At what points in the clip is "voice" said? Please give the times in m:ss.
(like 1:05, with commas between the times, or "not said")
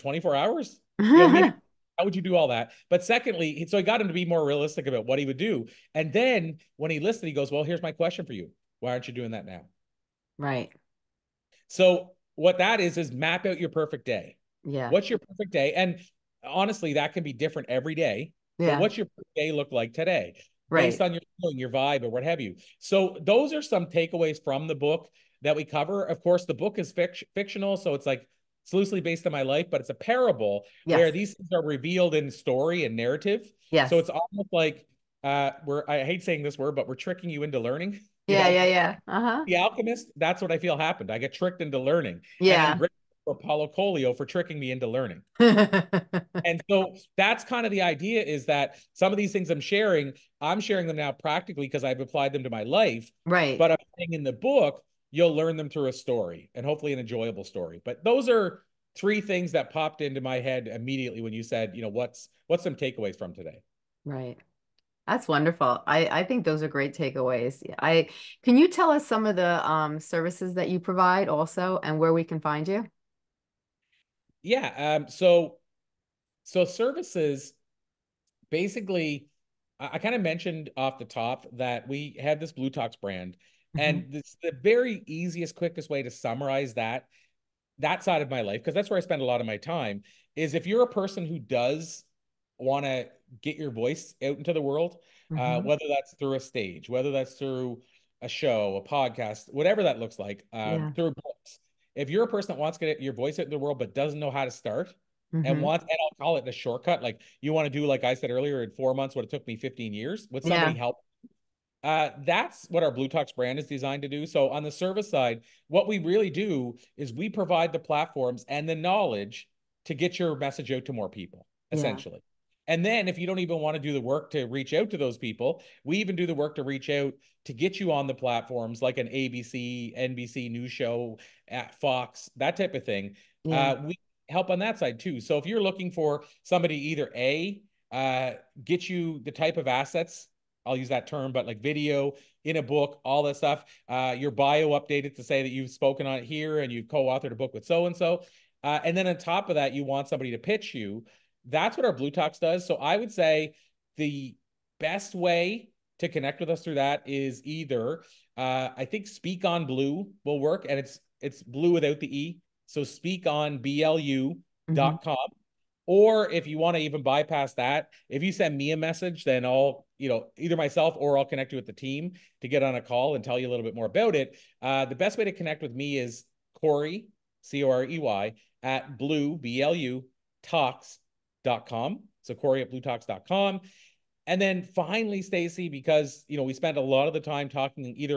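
1:33, 1:43.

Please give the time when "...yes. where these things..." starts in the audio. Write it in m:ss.
0:30.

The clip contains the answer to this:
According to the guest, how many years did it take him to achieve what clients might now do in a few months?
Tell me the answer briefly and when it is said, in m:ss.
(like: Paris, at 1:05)
15, at 1:49.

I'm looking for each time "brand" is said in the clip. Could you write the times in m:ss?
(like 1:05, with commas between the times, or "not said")
1:22, 1:53.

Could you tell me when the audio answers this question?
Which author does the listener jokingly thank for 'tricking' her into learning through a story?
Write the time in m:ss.
0:43.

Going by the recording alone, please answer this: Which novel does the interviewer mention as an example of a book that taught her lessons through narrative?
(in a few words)
The Alchemist.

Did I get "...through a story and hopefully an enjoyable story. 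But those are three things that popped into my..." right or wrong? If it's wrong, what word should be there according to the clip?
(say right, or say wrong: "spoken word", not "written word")
right.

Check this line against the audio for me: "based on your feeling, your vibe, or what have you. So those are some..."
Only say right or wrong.
right.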